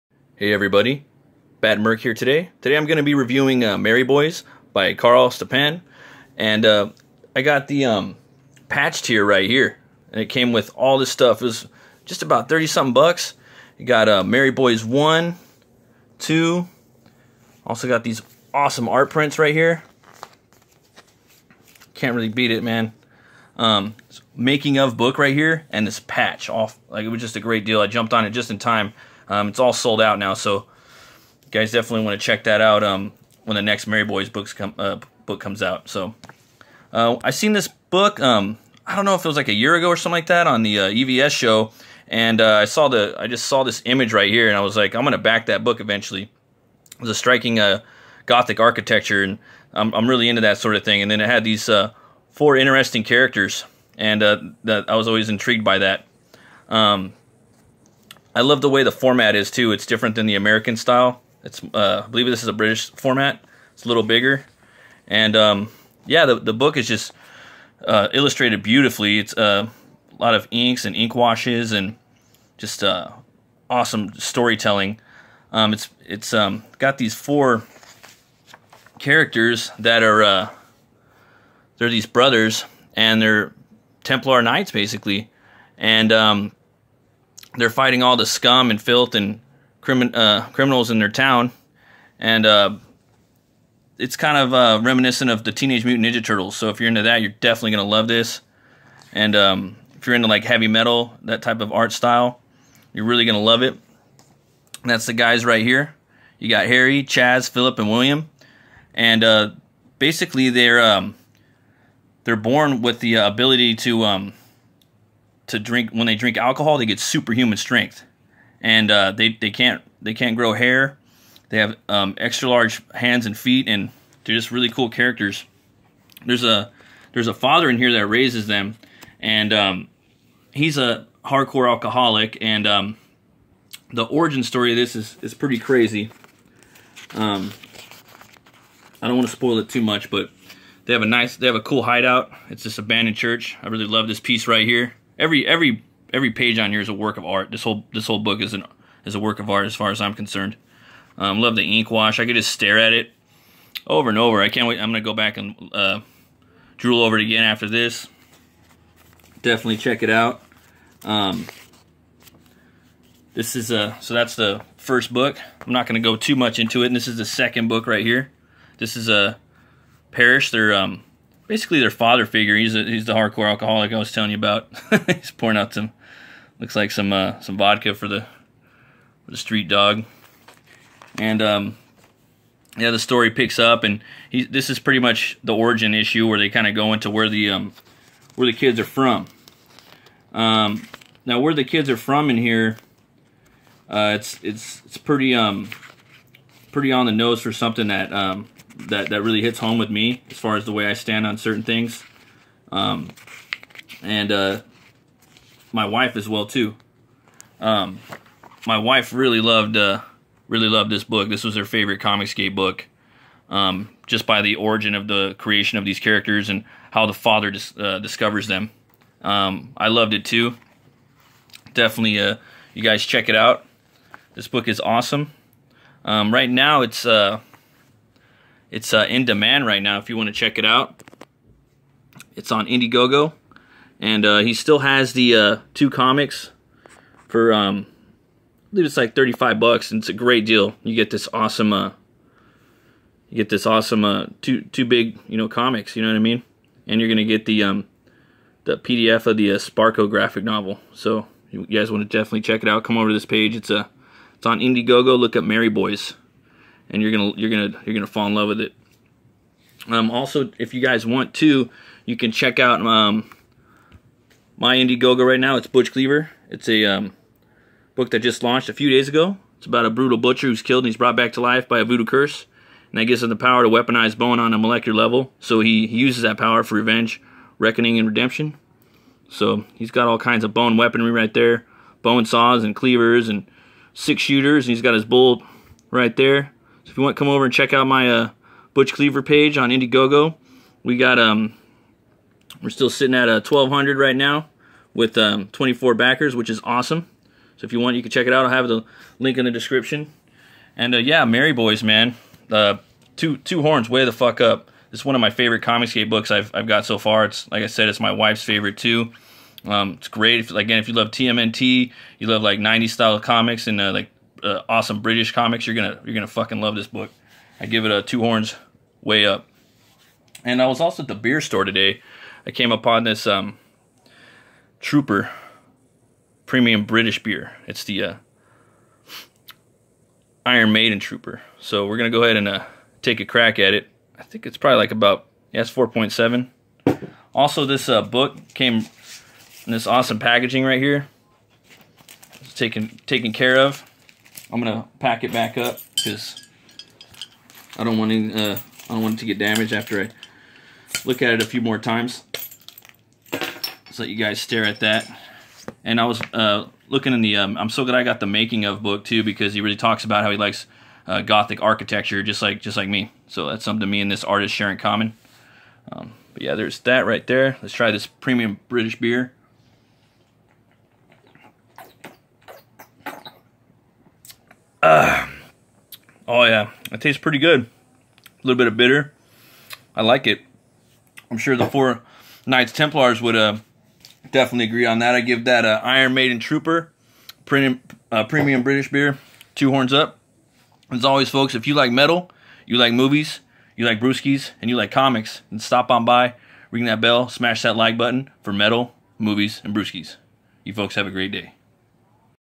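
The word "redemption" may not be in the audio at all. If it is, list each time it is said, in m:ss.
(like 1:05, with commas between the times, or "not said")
4:38.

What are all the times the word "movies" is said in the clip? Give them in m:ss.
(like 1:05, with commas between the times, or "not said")
6:32, 6:39.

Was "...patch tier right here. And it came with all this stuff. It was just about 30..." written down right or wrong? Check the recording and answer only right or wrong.
right.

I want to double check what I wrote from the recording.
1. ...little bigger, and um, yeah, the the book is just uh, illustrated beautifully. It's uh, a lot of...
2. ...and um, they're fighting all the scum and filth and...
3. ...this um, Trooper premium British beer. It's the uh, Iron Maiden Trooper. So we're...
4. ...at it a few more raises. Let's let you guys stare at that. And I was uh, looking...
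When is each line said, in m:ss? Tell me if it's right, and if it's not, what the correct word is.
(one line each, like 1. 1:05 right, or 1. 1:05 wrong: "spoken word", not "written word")
1. 1:03 right
2. 1:25 right
3. 5:23 right
4. 5:51 wrong: "times", not "raises".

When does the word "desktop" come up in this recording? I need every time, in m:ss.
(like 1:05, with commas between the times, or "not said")
not said.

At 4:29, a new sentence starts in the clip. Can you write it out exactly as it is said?
It's about a brutal butcher who's killed and he's brought back to life by a voodoo curse.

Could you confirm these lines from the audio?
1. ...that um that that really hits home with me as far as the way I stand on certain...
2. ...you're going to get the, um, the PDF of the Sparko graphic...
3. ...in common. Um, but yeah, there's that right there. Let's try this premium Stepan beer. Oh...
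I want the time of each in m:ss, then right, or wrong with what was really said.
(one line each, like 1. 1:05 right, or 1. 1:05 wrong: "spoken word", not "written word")
1. 3:17 right
2. 4:06 right
3. 6:04 wrong: "British", not "Stepan".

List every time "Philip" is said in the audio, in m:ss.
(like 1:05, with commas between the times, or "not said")
1:47.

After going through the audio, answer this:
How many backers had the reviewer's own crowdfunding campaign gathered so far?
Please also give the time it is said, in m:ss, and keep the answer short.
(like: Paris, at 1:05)
24, at 4:55.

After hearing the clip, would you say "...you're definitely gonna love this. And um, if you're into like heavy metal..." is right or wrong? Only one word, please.
right.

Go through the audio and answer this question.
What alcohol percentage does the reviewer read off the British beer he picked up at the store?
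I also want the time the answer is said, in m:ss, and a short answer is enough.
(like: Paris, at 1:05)
4.7, at 5:35.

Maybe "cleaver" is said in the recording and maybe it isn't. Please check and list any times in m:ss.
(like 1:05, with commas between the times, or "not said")
4:25, 4:42, 4:48.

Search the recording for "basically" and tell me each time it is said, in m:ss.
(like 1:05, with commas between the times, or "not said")
1:24, 1:49, 2:51.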